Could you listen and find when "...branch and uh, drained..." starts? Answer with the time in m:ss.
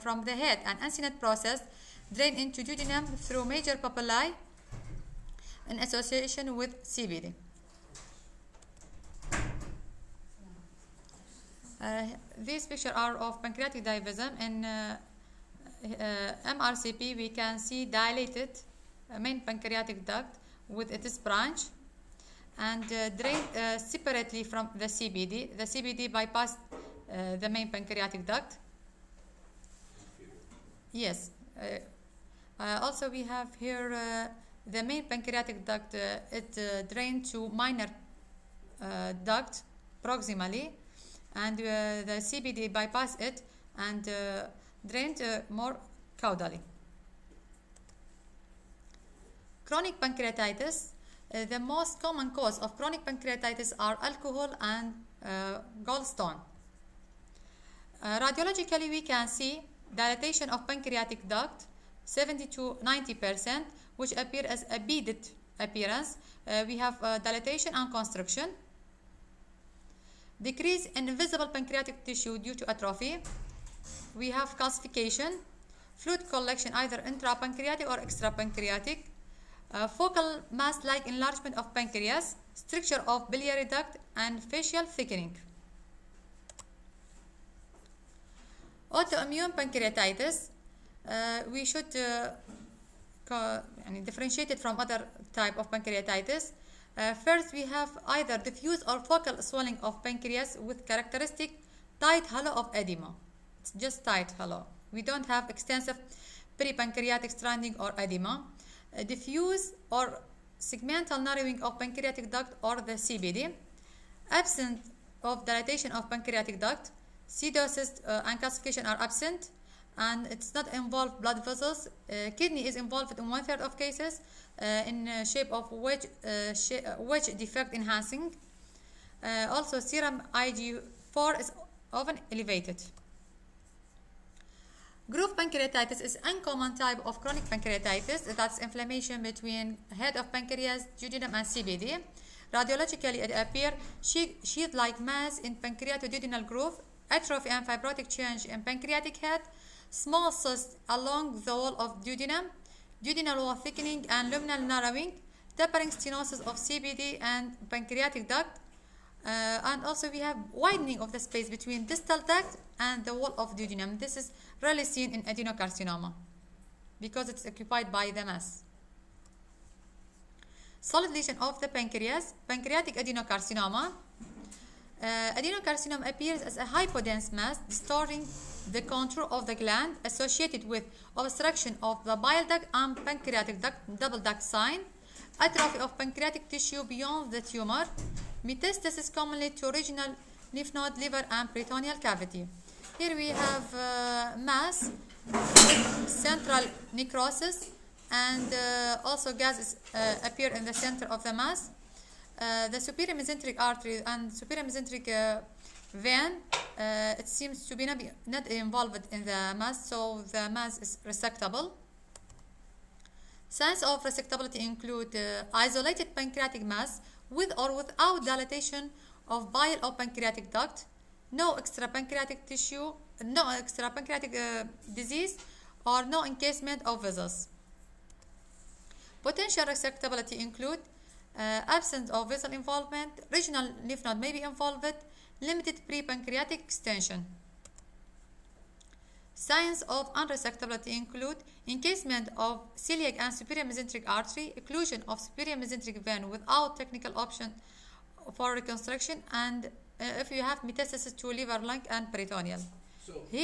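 0:21.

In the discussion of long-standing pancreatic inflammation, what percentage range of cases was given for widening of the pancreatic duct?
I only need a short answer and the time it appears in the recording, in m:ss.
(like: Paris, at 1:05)
70 to 90%, at 1:02.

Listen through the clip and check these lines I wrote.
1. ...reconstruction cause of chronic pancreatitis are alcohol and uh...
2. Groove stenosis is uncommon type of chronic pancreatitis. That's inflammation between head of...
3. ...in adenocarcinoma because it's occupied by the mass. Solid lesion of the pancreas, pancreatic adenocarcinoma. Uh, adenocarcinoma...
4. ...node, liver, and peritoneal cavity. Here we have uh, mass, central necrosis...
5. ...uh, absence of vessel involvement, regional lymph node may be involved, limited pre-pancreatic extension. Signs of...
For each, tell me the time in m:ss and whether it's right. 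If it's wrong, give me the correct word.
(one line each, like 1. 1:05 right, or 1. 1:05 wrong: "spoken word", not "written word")
1. 0:52 wrong: "common", not "reconstruction"
2. 2:15 wrong: "pancreatitis", not "stenosis"
3. 2:45 right
4. 3:10 right
5. 3:51 right.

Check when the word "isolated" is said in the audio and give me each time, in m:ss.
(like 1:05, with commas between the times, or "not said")
3:35.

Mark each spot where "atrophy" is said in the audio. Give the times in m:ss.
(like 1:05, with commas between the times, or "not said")
1:12, 2:27, 3:05.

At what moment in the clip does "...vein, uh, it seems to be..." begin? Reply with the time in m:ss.
3:25.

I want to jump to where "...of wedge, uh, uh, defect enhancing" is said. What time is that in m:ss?
2:05.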